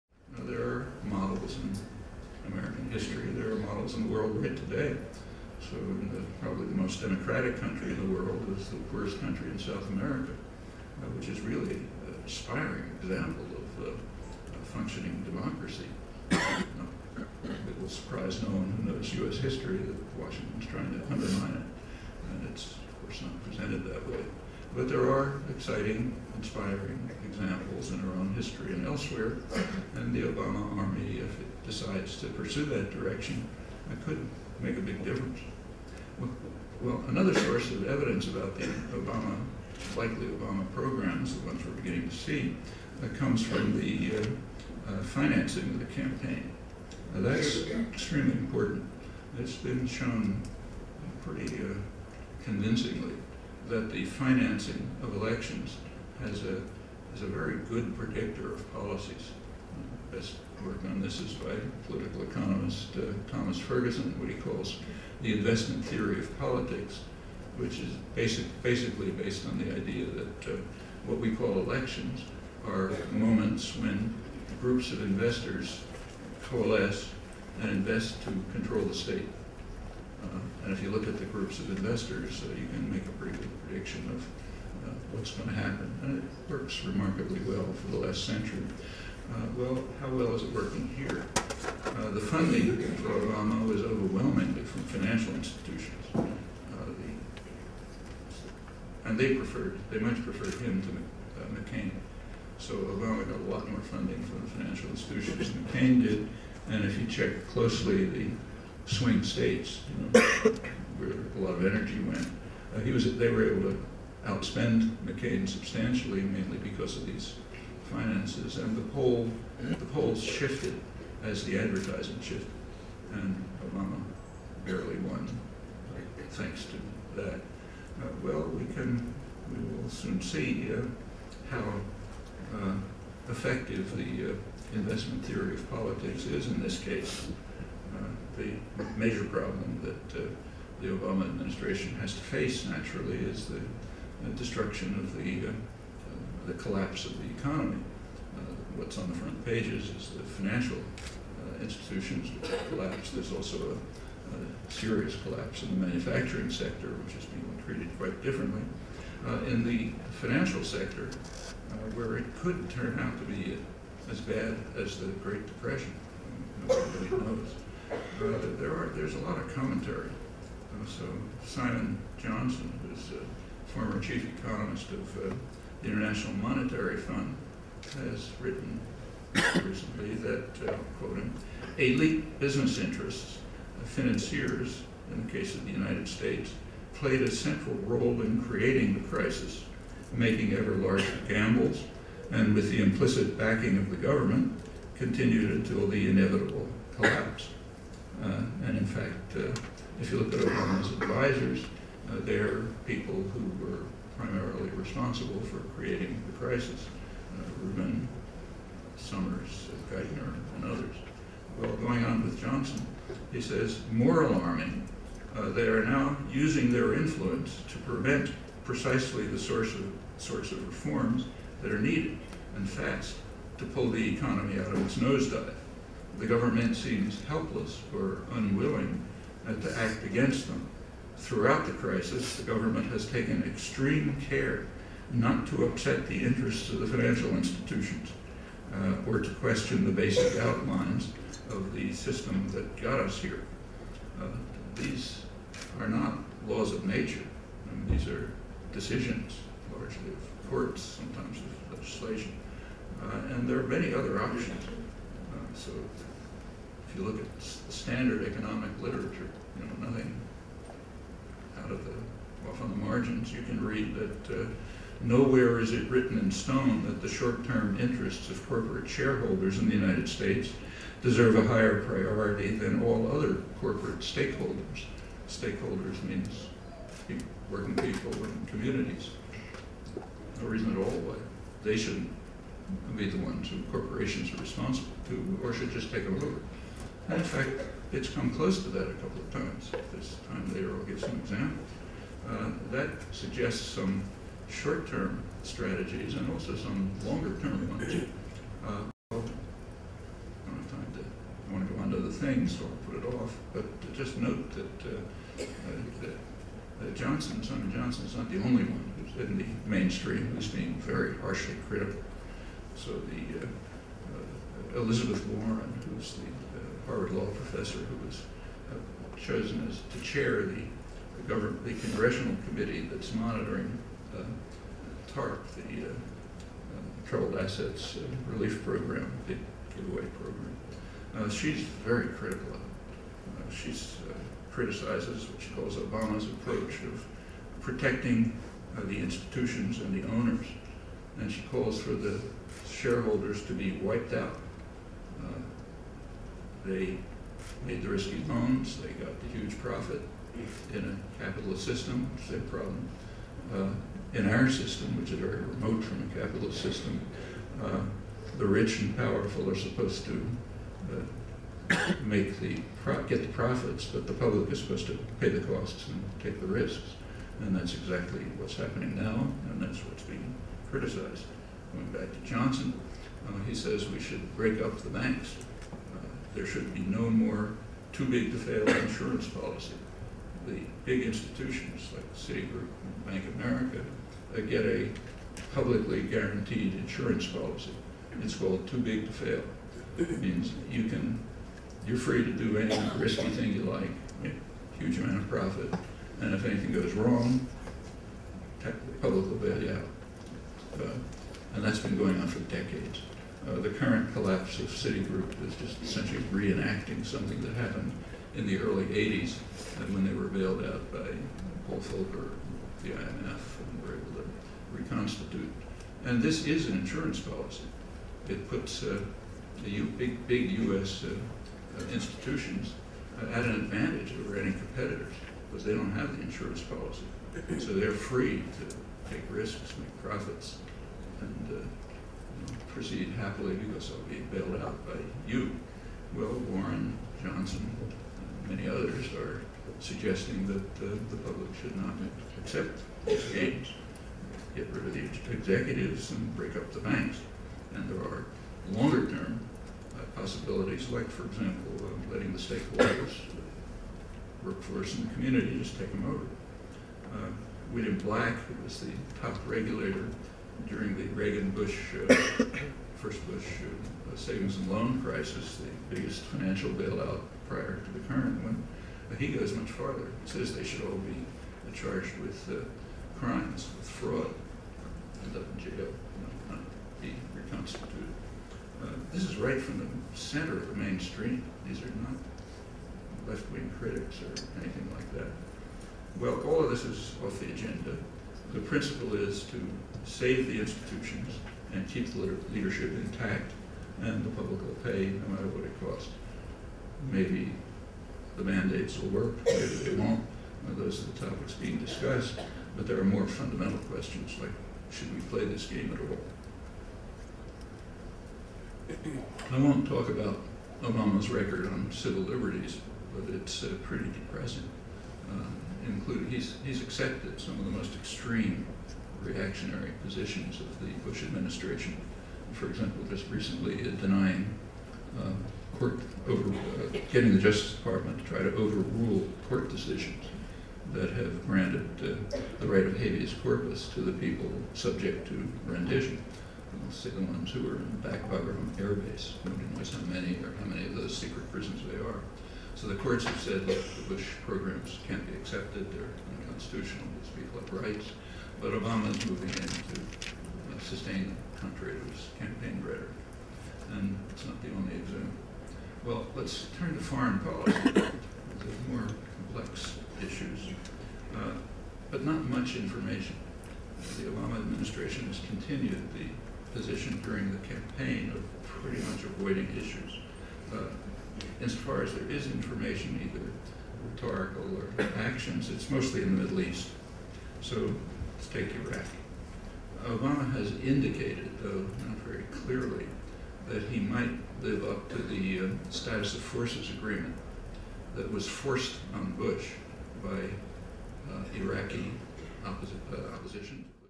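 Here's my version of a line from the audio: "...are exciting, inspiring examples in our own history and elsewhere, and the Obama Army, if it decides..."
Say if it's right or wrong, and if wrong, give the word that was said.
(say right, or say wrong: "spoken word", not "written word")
right.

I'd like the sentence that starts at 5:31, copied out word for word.
Uh, she's very critical of it.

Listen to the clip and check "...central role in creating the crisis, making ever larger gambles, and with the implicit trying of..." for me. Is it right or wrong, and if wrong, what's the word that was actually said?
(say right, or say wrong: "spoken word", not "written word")
wrong: "backing", not "trying".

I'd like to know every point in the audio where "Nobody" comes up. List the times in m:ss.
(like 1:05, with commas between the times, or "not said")
2:46, 8:59.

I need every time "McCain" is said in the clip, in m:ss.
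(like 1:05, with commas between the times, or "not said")
1:41, 1:45, 1:55.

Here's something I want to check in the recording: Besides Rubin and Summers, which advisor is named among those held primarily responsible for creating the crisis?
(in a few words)
Geithner.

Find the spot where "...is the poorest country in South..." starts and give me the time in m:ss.
0:08.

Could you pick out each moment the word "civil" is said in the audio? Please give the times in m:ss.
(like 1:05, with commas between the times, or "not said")
8:31.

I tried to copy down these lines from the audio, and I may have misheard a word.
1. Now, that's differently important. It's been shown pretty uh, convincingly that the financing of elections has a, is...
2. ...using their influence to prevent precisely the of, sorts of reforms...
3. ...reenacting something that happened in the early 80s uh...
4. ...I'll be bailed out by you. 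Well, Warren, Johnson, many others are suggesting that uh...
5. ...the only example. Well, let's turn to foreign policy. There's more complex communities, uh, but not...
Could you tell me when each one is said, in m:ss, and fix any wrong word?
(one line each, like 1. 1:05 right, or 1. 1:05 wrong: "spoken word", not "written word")
1. 0:47 wrong: "extremely", not "differently"
2. 3:36 right
3. 6:46 right
4. 7:13 right
5. 9:14 wrong: "issues", not "communities".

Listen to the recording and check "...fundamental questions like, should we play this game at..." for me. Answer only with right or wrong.
right.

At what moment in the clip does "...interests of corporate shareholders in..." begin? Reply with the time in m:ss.
4:27.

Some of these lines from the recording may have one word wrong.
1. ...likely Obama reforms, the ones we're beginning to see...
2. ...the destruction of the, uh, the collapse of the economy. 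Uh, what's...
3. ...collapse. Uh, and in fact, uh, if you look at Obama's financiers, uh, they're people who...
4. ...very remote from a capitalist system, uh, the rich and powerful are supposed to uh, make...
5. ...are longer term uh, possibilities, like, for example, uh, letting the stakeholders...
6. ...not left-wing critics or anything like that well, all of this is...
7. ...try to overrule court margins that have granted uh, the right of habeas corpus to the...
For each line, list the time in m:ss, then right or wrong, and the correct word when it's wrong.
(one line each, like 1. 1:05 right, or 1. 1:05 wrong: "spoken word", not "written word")
1. 0:39 wrong: "programs", not "reforms"
2. 2:23 right
3. 3:16 wrong: "advisors", not "financiers"
4. 5:55 right
5. 7:28 right
6. 8:01 right
7. 8:48 wrong: "decisions", not "margins".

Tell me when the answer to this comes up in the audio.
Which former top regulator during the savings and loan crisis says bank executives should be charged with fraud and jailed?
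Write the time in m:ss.
7:37.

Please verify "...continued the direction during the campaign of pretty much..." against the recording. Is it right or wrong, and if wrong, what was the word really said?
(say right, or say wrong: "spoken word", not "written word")
wrong: "position", not "direction".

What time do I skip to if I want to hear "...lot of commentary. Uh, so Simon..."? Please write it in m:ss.
2:49.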